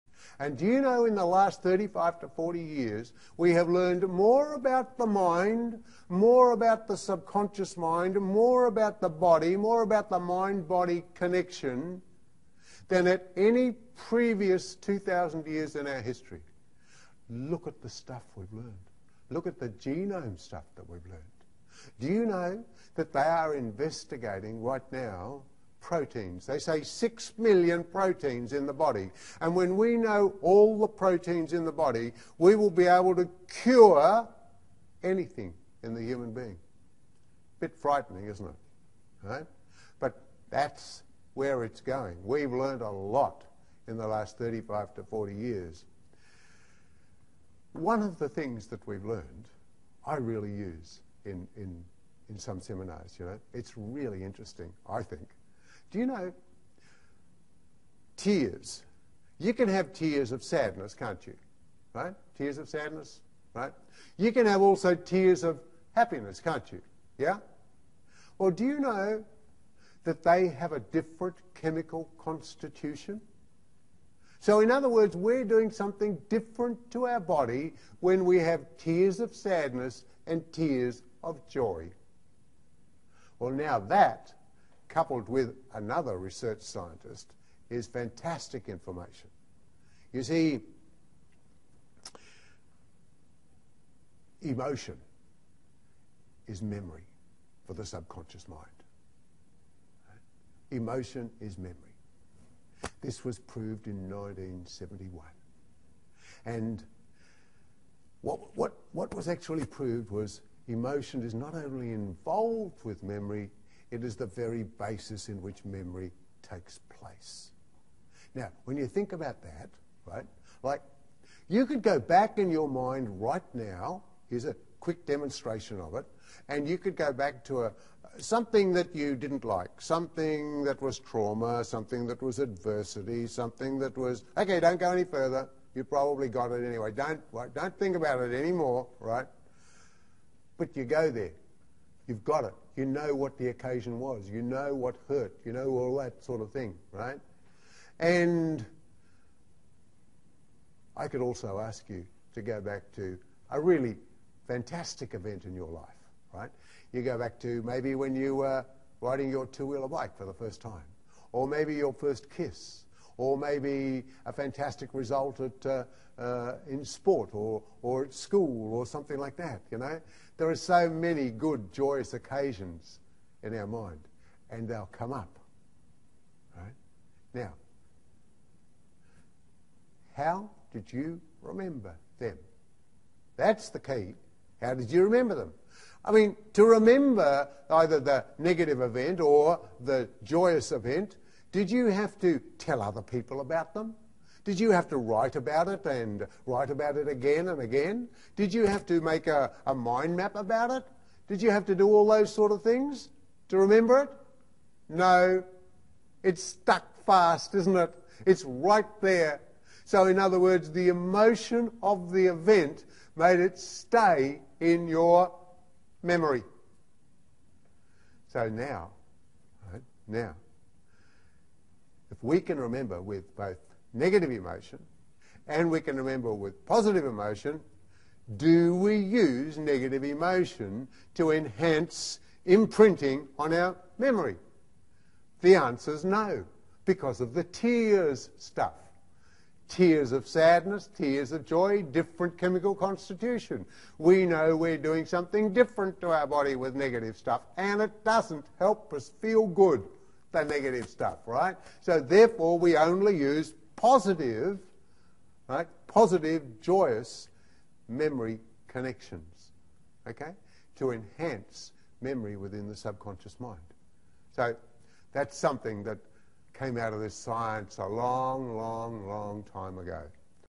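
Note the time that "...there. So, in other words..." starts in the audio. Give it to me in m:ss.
3:29.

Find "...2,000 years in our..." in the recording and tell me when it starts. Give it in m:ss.
0:14.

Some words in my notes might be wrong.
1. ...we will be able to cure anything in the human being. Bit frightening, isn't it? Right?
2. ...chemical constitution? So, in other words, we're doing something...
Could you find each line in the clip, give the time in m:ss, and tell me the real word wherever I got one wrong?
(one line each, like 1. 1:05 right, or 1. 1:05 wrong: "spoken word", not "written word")
1. 0:32 right
2. 1:11 right.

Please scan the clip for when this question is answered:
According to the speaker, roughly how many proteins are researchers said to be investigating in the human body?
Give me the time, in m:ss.
0:26.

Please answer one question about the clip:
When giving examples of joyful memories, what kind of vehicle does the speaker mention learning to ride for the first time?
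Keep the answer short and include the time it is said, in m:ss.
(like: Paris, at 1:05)
two wheeler bike, at 2:39.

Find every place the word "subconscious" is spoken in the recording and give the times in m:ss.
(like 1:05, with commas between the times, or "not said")
0:06, 1:37, 4:22.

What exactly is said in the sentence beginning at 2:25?
You know all that sort of thing, right?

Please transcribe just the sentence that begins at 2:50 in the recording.
There are so many good, joyous occasions in our mind, and they'll come up.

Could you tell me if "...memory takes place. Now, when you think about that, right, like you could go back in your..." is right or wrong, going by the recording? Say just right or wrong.
right.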